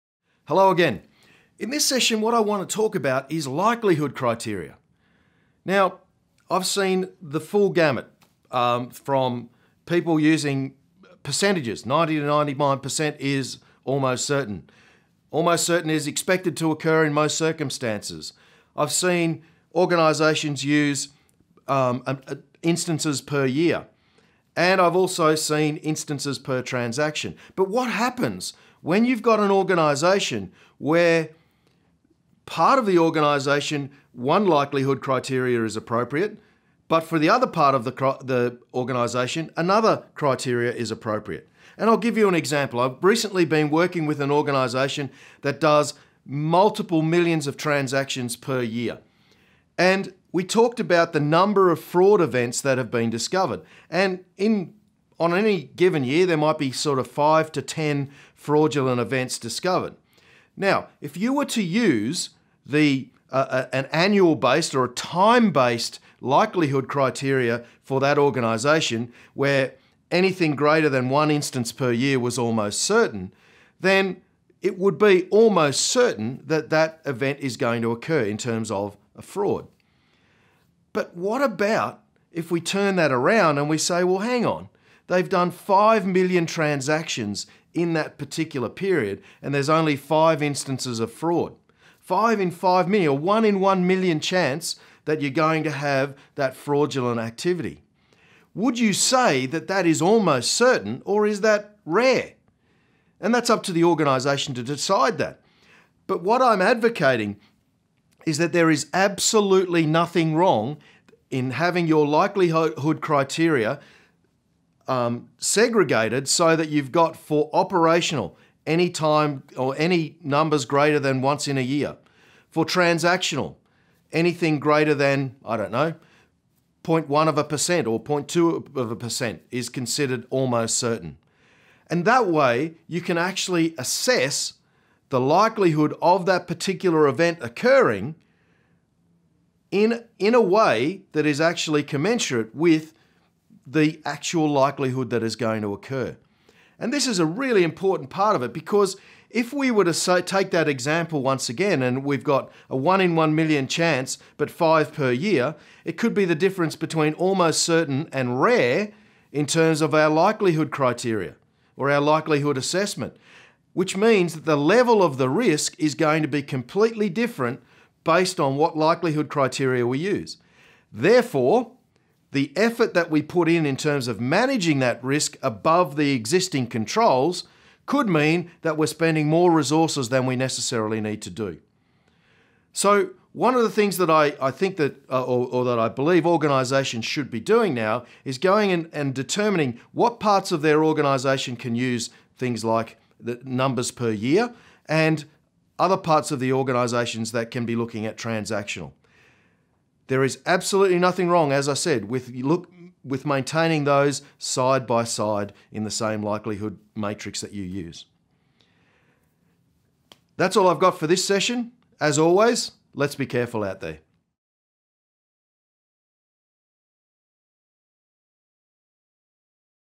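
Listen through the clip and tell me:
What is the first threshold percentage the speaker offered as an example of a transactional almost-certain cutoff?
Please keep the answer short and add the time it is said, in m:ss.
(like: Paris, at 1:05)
0.1%, at 2:06.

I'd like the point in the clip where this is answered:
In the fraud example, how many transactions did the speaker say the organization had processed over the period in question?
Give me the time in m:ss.
1:25.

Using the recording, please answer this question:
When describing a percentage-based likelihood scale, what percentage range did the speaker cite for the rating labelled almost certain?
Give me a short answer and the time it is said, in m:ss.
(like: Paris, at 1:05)
90 to 99%, at 0:11.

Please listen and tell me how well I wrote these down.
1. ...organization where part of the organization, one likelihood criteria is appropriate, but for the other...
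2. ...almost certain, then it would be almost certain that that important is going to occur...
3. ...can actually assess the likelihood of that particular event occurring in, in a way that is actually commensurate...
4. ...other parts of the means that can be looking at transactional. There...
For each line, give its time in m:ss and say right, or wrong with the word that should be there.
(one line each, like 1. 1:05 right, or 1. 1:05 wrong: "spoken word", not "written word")
1. 0:29 right
2. 1:12 wrong: "event", not "important"
3. 2:13 right
4. 3:15 wrong: "organizations", not "means".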